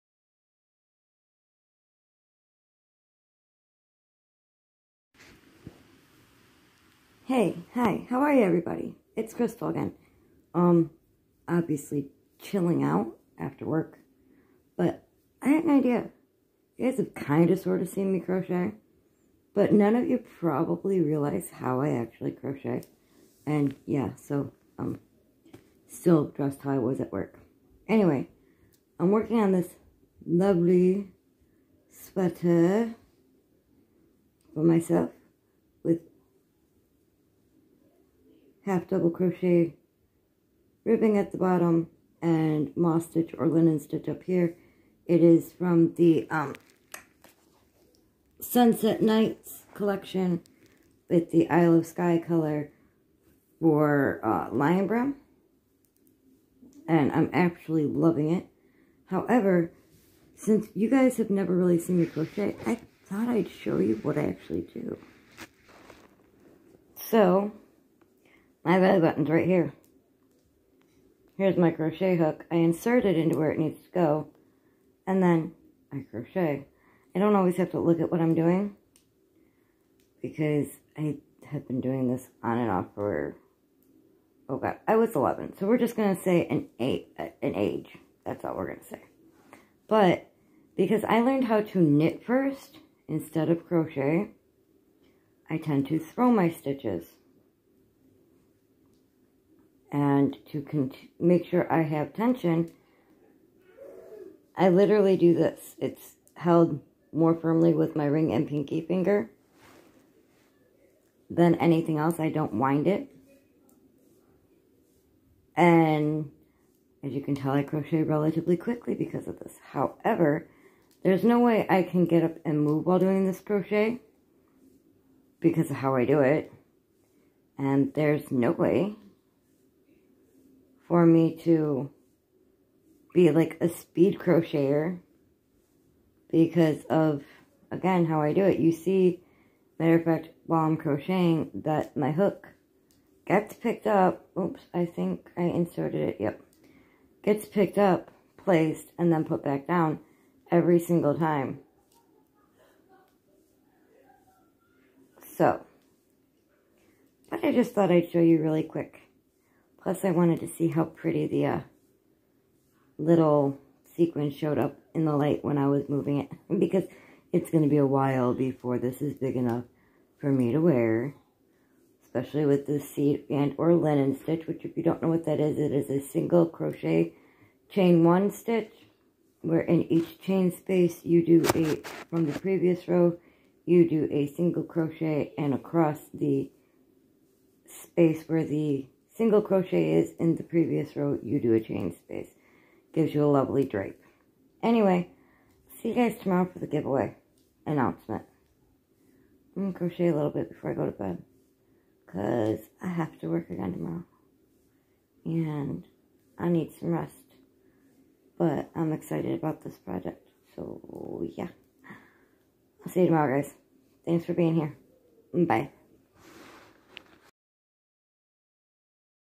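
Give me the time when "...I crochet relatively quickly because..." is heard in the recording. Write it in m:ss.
1:57.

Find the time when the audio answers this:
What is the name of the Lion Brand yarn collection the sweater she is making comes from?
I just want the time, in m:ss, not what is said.
0:48.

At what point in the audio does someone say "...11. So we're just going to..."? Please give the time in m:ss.
1:25.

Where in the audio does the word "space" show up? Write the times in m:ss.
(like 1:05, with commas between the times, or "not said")
3:00, 3:07, 3:11.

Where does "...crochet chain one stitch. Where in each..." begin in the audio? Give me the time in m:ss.
2:56.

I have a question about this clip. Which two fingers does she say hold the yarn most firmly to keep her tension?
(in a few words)
ring and pinky.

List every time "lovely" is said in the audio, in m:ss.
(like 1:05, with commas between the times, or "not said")
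0:30, 3:13.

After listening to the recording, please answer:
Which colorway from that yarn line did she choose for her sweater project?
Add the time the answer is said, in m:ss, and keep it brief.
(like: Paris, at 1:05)
Isle of Skye, at 0:51.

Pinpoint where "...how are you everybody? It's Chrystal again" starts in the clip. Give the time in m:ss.
0:08.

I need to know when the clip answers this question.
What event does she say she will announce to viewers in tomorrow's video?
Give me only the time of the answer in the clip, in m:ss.
3:16.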